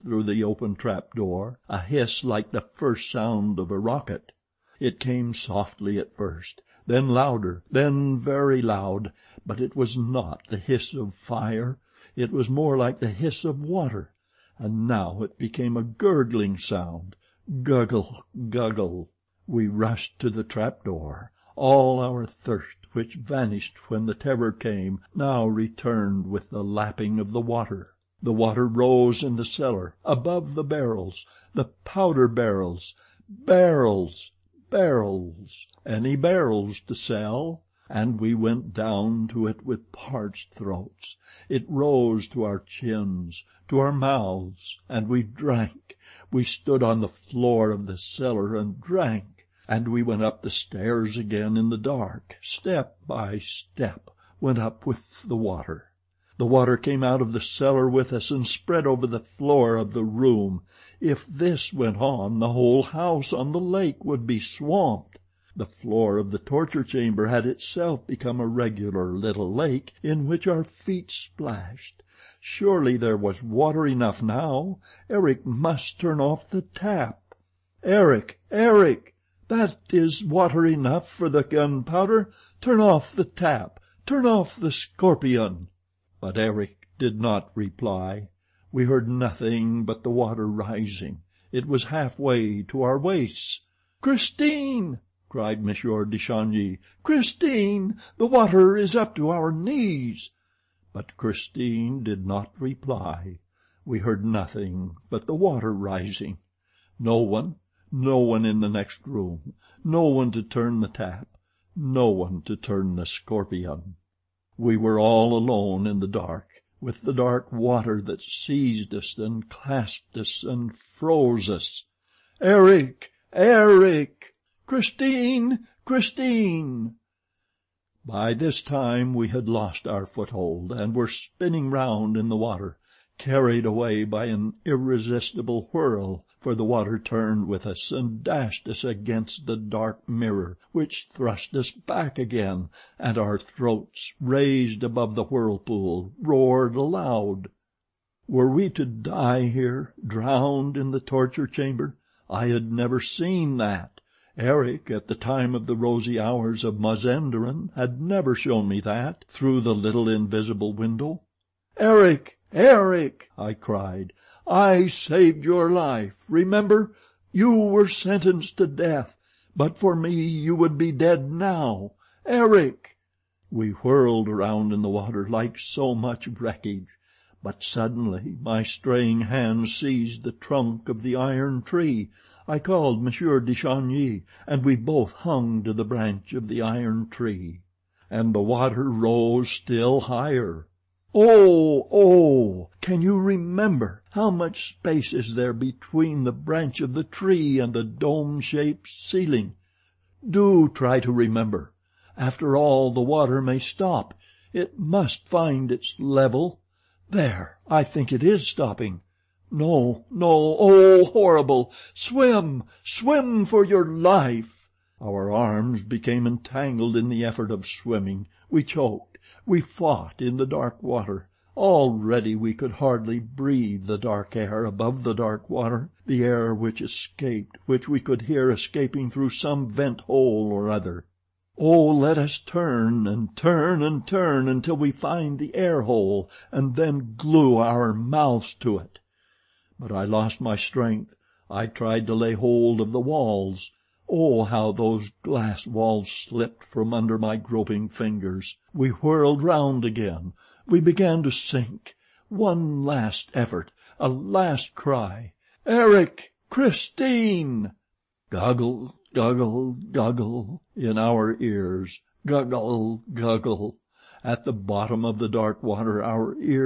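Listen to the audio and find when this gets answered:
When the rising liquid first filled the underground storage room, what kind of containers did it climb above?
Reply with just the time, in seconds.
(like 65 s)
31 s.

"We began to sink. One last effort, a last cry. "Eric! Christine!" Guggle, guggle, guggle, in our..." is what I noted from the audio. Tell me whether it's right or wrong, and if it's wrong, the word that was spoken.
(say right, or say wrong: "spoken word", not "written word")
right.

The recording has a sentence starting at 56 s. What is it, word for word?
The water came out of the cellar with us and spread over the floor of the room.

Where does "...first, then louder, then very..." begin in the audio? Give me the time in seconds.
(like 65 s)
6 s.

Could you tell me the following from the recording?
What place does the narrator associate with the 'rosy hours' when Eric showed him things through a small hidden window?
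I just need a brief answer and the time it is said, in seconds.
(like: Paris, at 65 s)
Mazenderan, at 156 s.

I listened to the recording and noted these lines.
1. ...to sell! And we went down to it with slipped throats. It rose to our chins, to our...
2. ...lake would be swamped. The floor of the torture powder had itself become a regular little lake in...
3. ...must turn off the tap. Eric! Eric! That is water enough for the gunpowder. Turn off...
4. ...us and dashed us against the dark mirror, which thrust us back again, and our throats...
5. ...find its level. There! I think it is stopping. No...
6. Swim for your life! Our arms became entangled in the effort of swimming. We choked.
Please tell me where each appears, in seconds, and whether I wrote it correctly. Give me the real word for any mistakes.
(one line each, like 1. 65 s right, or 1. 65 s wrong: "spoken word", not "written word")
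1. 36 s wrong: "parched", not "slipped"
2. 63 s wrong: "chamber", not "powder"
3. 75 s right
4. 137 s right
5. 205 s right
6. 212 s right.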